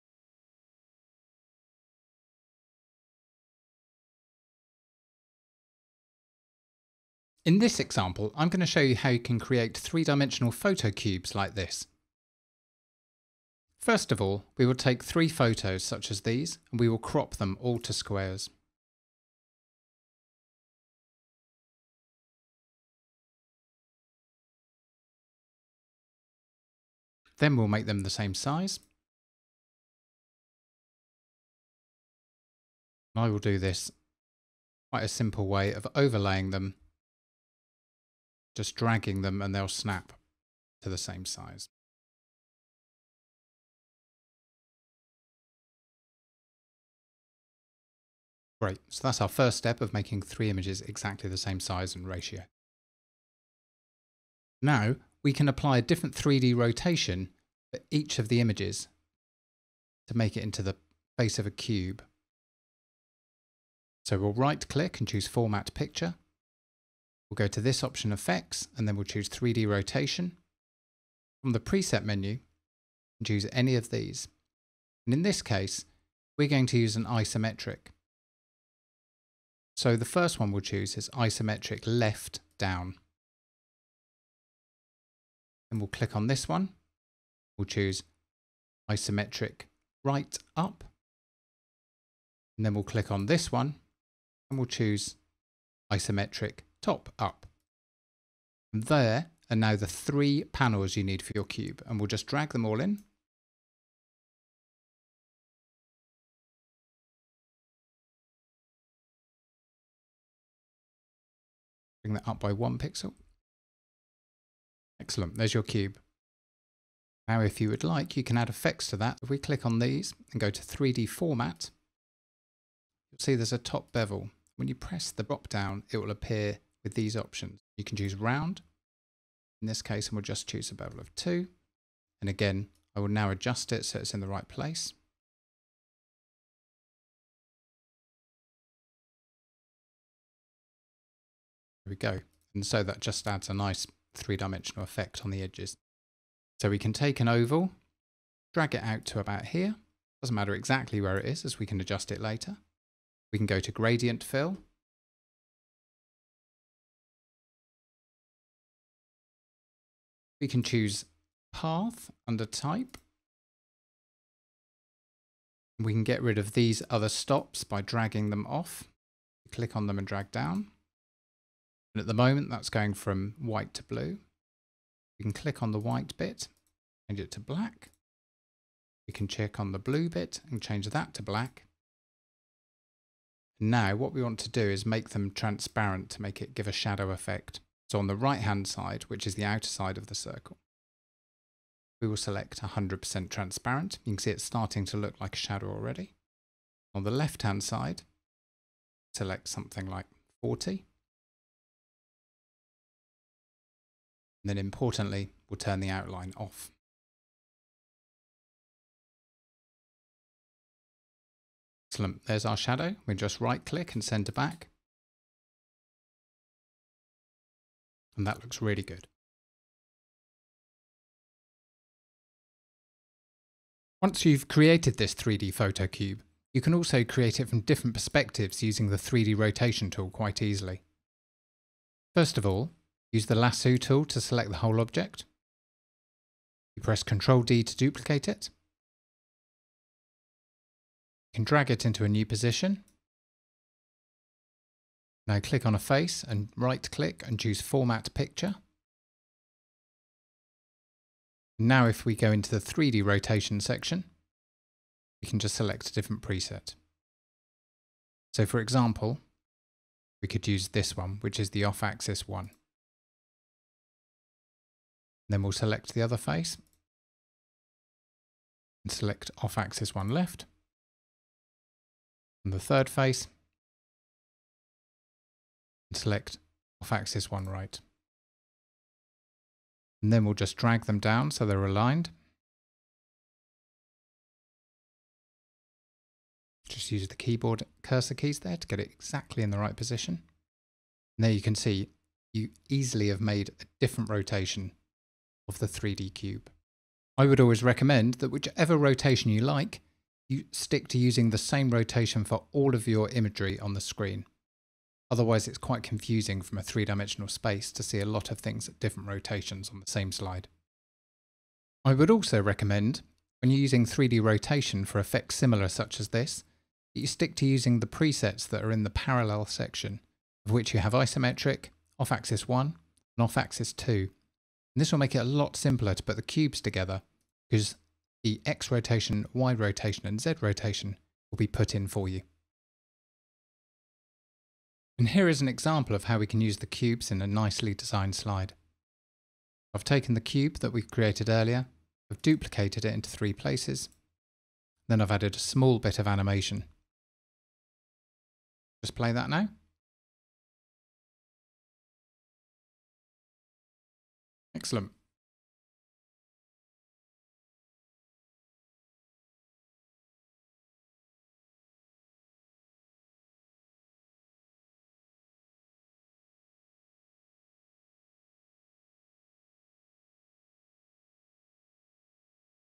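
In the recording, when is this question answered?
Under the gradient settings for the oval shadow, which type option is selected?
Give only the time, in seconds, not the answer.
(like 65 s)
161 s.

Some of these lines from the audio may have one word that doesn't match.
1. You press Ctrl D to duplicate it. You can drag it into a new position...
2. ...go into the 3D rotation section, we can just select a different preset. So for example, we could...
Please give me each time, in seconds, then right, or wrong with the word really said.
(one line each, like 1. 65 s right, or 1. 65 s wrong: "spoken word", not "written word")
1. 236 s right
2. 252 s right.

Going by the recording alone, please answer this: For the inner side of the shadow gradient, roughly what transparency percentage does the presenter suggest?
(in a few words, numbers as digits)
40.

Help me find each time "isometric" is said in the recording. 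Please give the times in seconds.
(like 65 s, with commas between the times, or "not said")
77 s, 81 s, 88 s, 95 s, 320 s.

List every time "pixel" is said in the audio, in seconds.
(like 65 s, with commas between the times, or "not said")
112 s.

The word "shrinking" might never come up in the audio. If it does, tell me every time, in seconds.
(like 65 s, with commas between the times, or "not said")
not said.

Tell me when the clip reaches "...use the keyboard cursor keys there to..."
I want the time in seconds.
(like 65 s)
286 s.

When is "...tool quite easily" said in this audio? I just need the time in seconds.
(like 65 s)
229 s.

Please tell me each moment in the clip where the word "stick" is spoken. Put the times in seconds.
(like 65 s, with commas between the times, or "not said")
300 s, 317 s.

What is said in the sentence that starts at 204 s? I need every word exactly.
And then importantly, we'll turn the outline off.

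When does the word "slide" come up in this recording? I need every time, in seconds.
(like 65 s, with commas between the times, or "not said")
310 s, 338 s.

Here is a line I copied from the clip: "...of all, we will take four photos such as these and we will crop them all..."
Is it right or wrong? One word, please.
wrong.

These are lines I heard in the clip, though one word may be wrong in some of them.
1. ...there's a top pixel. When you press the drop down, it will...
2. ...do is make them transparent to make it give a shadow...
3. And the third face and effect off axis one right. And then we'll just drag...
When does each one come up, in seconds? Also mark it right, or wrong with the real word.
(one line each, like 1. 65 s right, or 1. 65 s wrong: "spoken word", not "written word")
1. 123 s wrong: "bevel", not "pixel"
2. 184 s right
3. 272 s wrong: "select", not "effect".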